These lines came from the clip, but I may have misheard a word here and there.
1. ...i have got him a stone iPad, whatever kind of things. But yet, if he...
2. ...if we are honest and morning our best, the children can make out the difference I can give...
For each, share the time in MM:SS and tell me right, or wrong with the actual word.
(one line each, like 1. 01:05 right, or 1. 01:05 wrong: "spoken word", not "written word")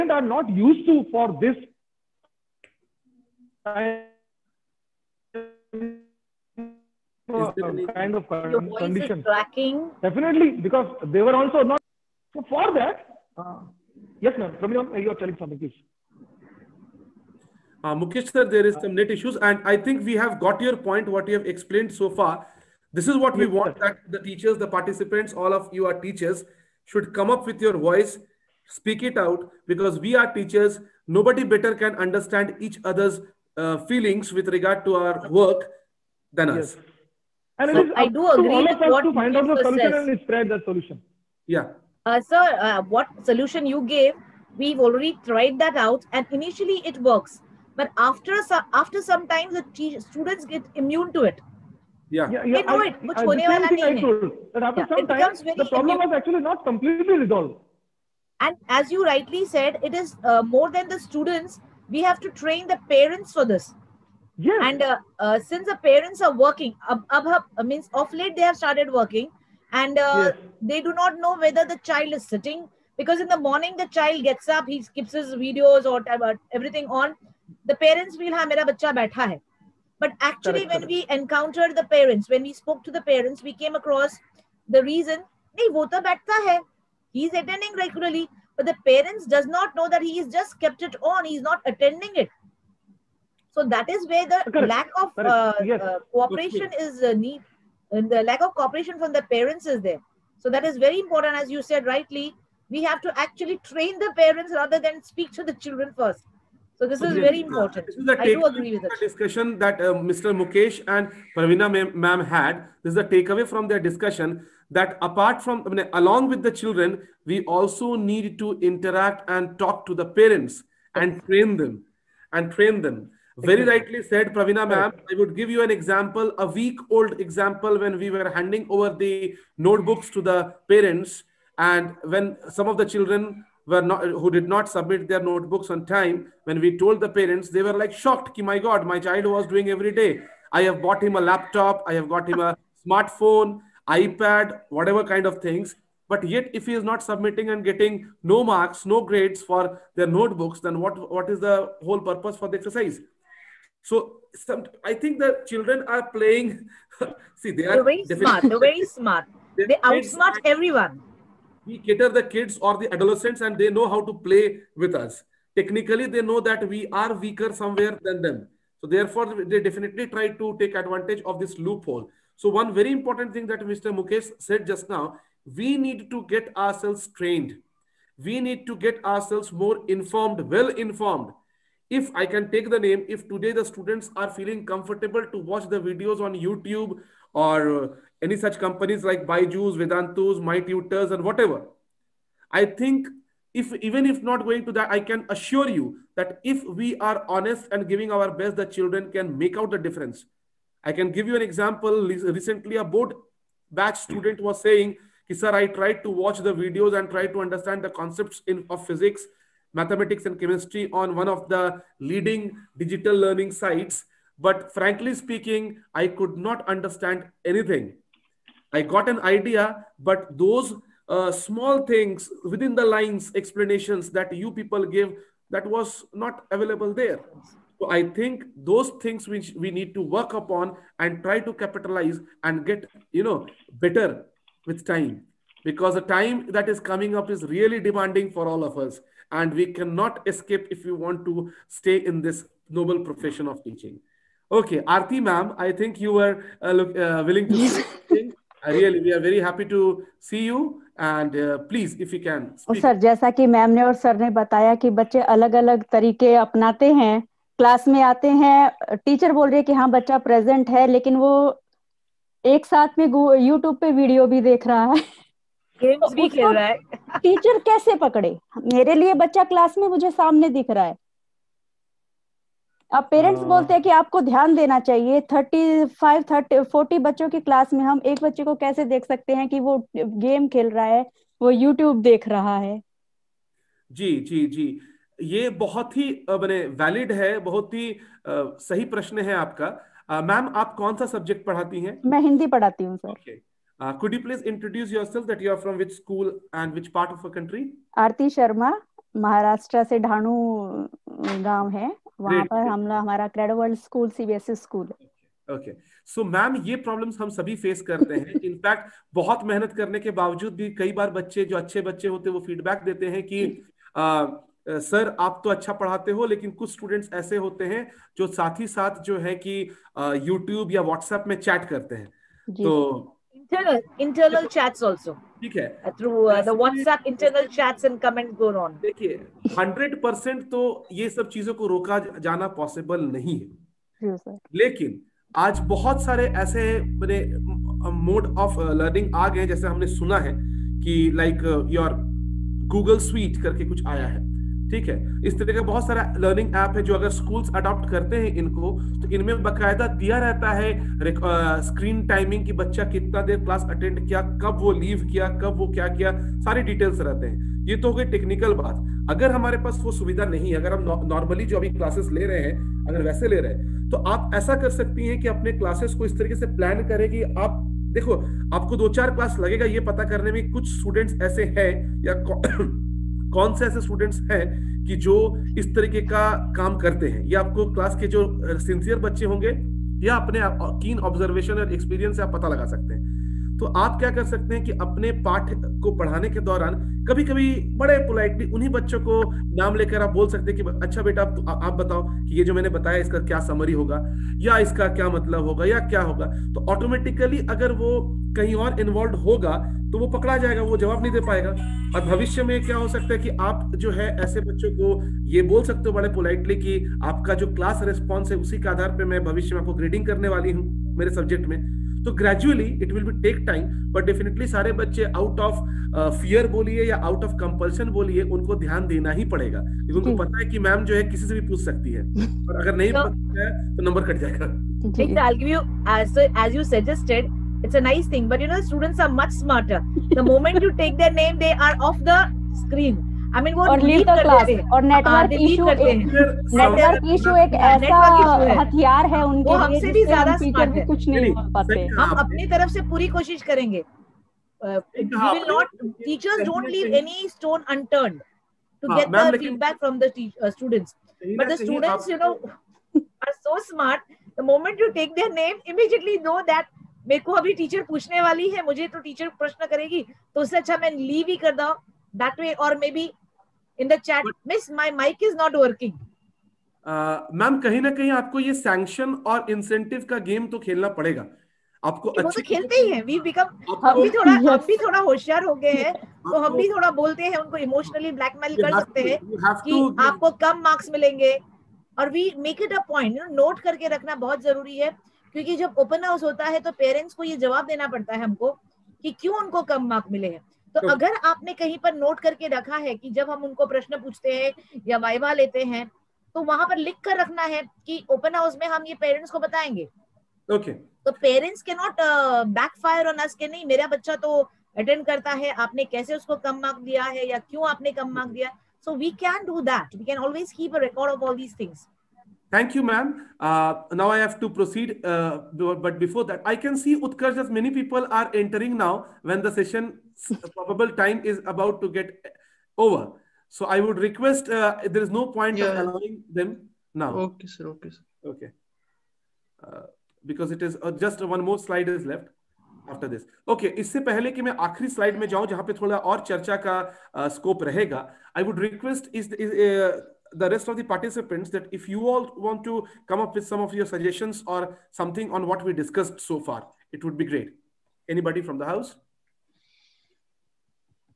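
1. 02:21 wrong: "smartphone", not "stone"
2. 03:16 wrong: "giving", not "morning".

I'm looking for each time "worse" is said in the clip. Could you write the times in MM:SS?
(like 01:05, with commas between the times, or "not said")
not said.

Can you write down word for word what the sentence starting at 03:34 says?
But frankly speaking, I could not understand anything.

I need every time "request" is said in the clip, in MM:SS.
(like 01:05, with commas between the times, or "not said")
08:43, 08:58.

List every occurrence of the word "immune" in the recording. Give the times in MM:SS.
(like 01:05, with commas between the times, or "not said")
00:50, 00:55.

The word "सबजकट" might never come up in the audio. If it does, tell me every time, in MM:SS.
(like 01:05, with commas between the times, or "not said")
04:51, 06:51.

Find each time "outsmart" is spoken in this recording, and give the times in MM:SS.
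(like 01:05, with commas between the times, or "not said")
02:39.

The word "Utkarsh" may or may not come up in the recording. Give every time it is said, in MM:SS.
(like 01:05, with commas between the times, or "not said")
08:37.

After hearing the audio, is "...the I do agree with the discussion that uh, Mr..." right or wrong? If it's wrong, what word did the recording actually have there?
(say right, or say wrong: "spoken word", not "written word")
right.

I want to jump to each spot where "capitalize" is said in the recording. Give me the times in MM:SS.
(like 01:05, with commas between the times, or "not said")
03:51.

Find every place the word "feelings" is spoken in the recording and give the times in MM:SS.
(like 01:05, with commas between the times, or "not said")
00:33, 03:04.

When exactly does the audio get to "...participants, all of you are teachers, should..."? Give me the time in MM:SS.
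00:24.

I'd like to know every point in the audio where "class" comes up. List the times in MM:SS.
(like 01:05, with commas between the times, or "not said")
07:14.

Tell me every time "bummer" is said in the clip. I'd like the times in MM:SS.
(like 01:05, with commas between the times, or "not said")
not said.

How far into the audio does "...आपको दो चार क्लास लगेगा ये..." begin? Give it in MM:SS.
06:08.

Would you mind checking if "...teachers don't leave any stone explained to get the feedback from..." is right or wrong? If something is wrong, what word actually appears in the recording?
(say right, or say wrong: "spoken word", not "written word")
wrong: "unturned", not "explained".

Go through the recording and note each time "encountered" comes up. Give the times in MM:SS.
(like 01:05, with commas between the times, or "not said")
01:21.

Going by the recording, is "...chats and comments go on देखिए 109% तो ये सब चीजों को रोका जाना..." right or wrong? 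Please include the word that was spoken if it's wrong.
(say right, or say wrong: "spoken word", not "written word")
wrong: "100", not "109".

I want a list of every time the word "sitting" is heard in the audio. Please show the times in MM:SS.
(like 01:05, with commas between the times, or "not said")
01:12.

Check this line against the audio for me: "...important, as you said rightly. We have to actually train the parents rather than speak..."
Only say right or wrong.
right.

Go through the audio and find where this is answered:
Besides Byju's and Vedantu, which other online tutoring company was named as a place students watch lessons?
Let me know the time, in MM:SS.
03:10.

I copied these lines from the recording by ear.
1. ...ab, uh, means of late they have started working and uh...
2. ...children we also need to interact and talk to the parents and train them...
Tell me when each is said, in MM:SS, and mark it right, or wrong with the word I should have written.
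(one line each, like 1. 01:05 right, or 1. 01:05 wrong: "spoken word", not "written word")
1. 01:07 right
2. 01:56 right.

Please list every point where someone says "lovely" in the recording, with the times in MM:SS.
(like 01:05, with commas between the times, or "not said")
not said.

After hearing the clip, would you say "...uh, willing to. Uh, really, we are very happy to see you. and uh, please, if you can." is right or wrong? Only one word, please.
right.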